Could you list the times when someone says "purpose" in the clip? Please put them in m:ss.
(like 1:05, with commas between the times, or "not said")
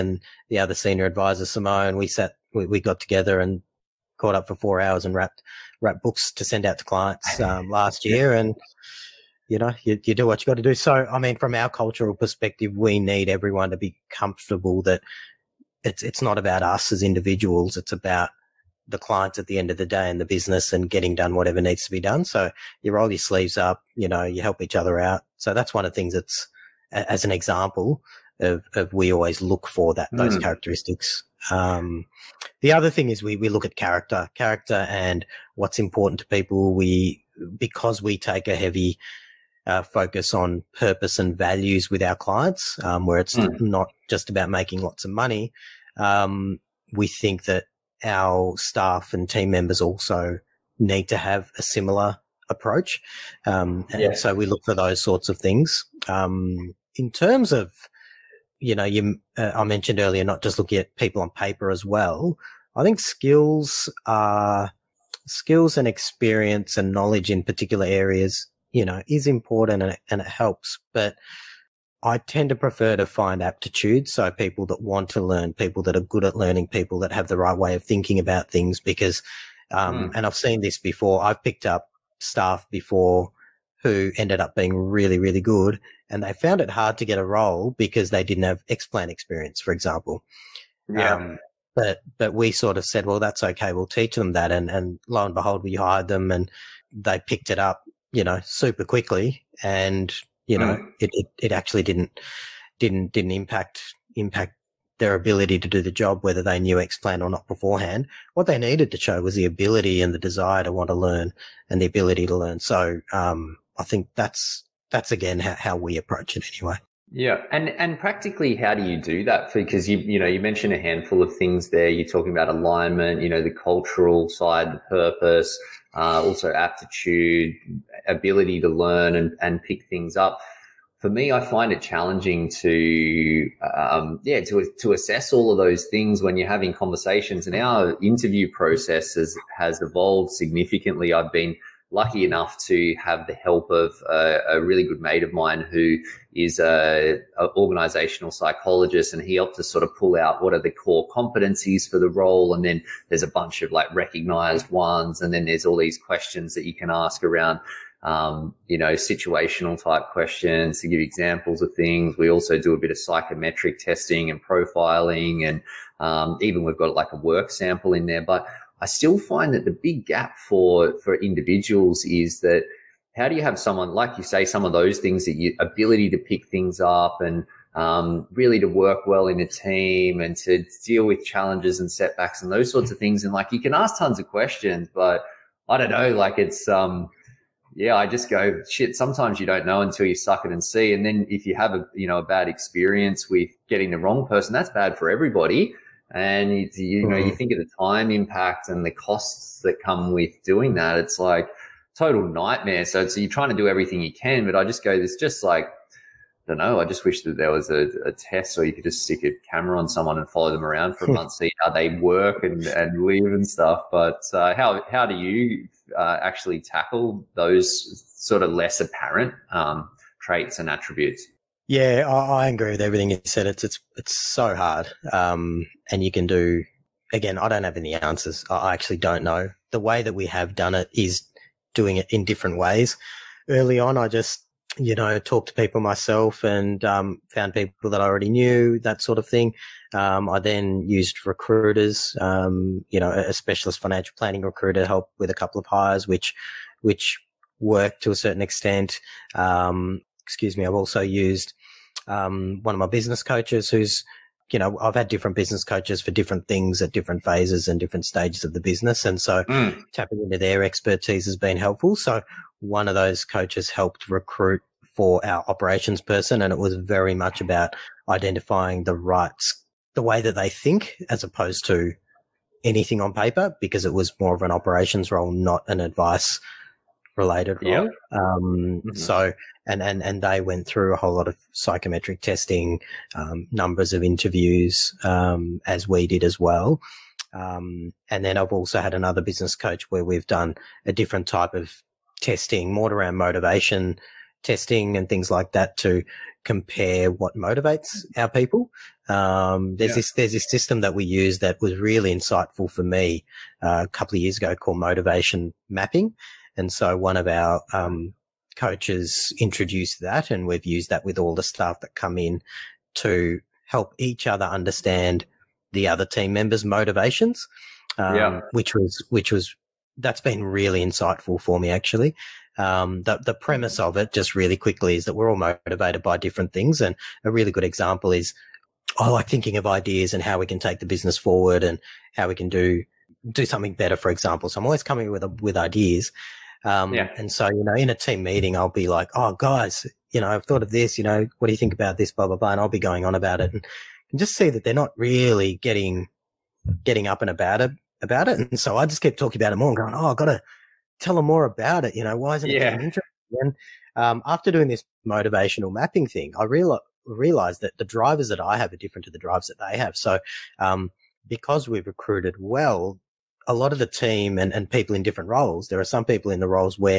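0:40, 2:04.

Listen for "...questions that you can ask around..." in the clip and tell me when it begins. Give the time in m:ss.
2:35.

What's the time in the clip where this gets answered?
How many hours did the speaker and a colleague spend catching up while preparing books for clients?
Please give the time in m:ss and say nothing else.
0:04.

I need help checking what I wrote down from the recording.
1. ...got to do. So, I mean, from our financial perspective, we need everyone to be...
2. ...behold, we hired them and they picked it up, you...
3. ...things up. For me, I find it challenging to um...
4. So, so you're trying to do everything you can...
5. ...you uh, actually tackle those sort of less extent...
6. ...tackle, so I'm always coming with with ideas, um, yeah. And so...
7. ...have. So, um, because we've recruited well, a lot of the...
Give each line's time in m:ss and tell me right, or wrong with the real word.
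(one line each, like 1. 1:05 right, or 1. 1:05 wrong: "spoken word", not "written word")
1. 0:10 wrong: "cultural", not "financial"
2. 1:35 right
3. 2:09 right
4. 3:22 right
5. 3:35 wrong: "apparent", not "extent"
6. 5:34 wrong: "example", not "tackle"
7. 5:59 right.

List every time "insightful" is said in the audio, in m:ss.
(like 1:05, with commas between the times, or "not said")
5:02, 5:20.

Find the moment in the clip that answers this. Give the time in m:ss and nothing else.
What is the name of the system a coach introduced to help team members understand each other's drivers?
5:04.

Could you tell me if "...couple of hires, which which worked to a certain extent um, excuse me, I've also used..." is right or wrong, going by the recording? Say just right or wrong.
right.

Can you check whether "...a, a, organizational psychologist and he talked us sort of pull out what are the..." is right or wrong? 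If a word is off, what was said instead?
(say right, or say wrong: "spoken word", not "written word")
wrong: "helped", not "talked".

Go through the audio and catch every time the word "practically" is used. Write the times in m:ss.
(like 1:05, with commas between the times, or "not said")
1:57.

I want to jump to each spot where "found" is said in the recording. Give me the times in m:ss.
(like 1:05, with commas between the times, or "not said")
1:26, 3:57.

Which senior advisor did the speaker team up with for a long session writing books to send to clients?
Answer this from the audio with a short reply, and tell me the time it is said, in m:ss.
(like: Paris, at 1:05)
Simone, at 0:01.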